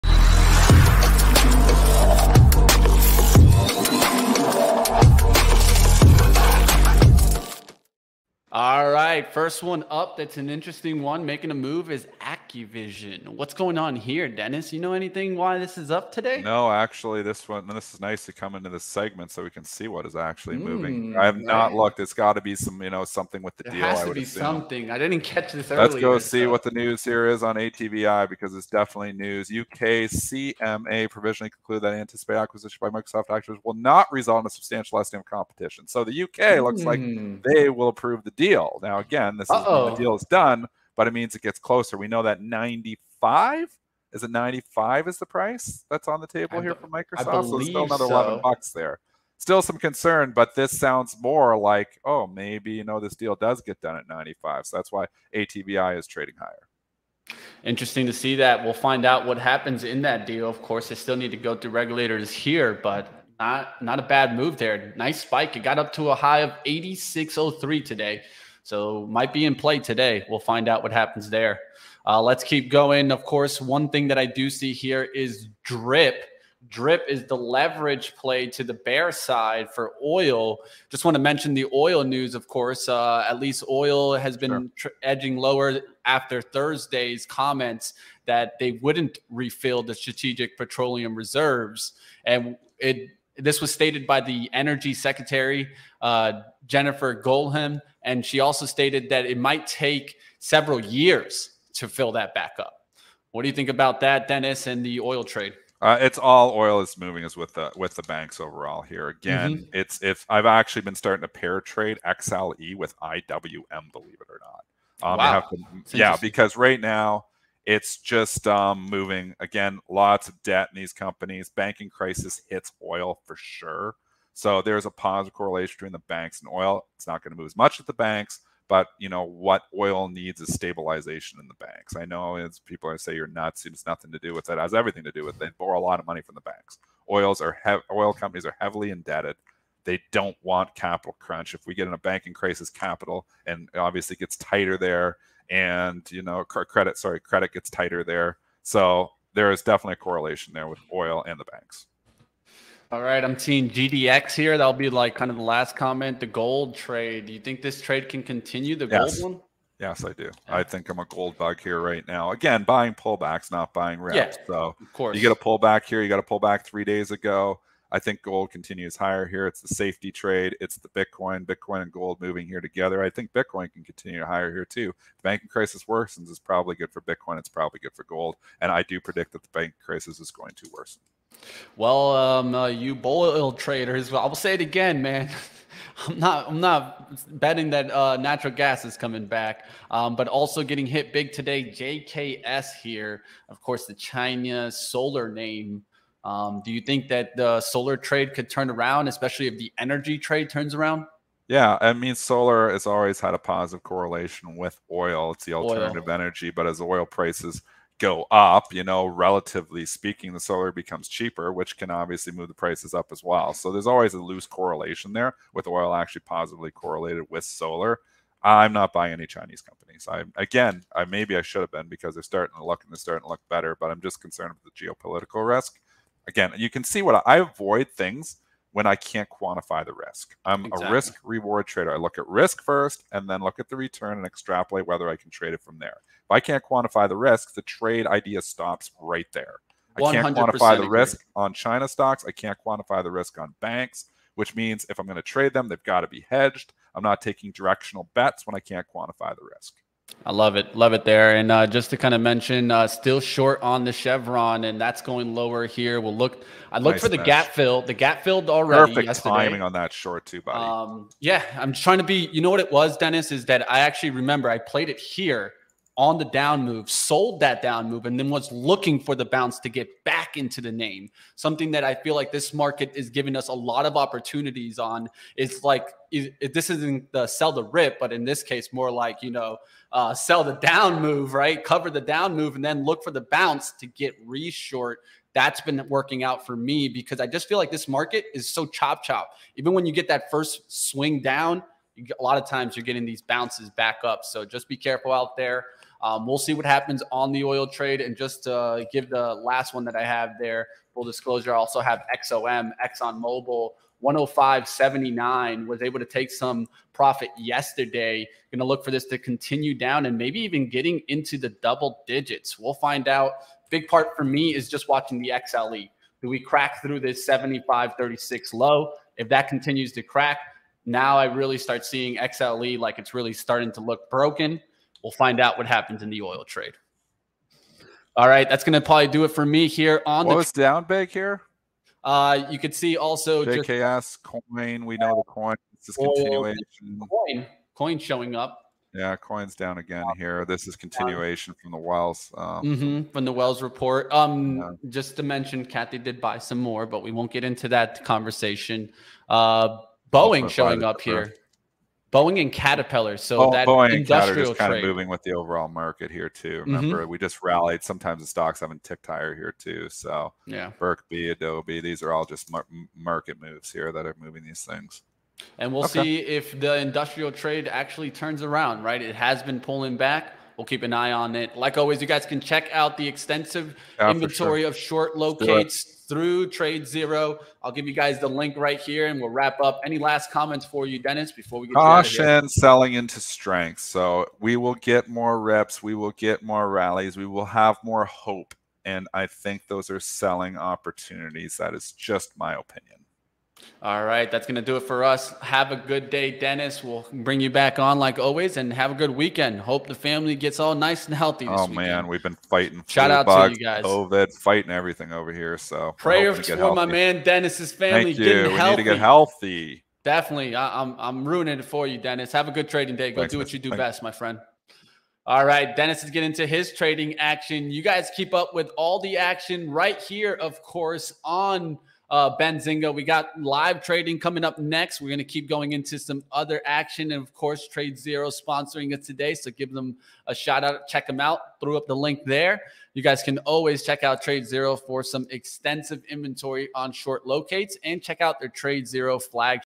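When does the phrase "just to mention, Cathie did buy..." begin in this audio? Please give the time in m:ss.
5:44.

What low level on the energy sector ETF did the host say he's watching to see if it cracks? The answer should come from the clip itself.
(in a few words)
75.36.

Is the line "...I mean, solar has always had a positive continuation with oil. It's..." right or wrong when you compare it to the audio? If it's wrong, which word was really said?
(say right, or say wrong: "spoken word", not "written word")
wrong: "correlation", not "continuation".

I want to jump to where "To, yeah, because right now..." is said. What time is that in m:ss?
1:55.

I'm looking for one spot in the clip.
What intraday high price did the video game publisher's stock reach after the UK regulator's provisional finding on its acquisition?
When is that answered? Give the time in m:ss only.
1:06.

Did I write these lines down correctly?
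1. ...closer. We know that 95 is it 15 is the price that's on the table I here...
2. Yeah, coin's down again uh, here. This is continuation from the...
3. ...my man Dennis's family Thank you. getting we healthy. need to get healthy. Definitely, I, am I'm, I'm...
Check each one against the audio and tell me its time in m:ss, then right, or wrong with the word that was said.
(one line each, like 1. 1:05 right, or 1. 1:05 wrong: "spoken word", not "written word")
1. 0:41 wrong: "95", not "15"
2. 5:38 right
3. 6:46 right.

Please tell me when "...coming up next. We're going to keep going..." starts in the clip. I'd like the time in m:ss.
7:04.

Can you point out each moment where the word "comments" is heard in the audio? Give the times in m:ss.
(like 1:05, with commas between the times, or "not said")
1:27, 2:35, 6:20.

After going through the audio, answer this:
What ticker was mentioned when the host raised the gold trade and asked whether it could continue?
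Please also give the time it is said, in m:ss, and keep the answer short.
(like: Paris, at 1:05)
GDX, at 2:33.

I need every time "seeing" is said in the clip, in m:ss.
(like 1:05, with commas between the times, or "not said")
2:33, 5:21.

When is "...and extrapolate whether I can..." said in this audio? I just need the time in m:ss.
3:54.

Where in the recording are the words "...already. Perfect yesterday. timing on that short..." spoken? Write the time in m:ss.
4:18.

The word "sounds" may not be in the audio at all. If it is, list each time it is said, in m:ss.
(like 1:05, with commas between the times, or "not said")
0:50.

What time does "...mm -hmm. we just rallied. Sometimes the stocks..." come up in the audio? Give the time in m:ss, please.
5:56.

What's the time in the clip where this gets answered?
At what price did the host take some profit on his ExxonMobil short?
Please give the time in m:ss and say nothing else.
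5:04.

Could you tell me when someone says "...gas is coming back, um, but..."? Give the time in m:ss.
3:08.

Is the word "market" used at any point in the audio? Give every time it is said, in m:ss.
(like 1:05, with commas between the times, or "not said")
4:32, 4:47, 5:55, 6:02.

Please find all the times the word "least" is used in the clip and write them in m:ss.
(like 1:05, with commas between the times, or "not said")
1:23.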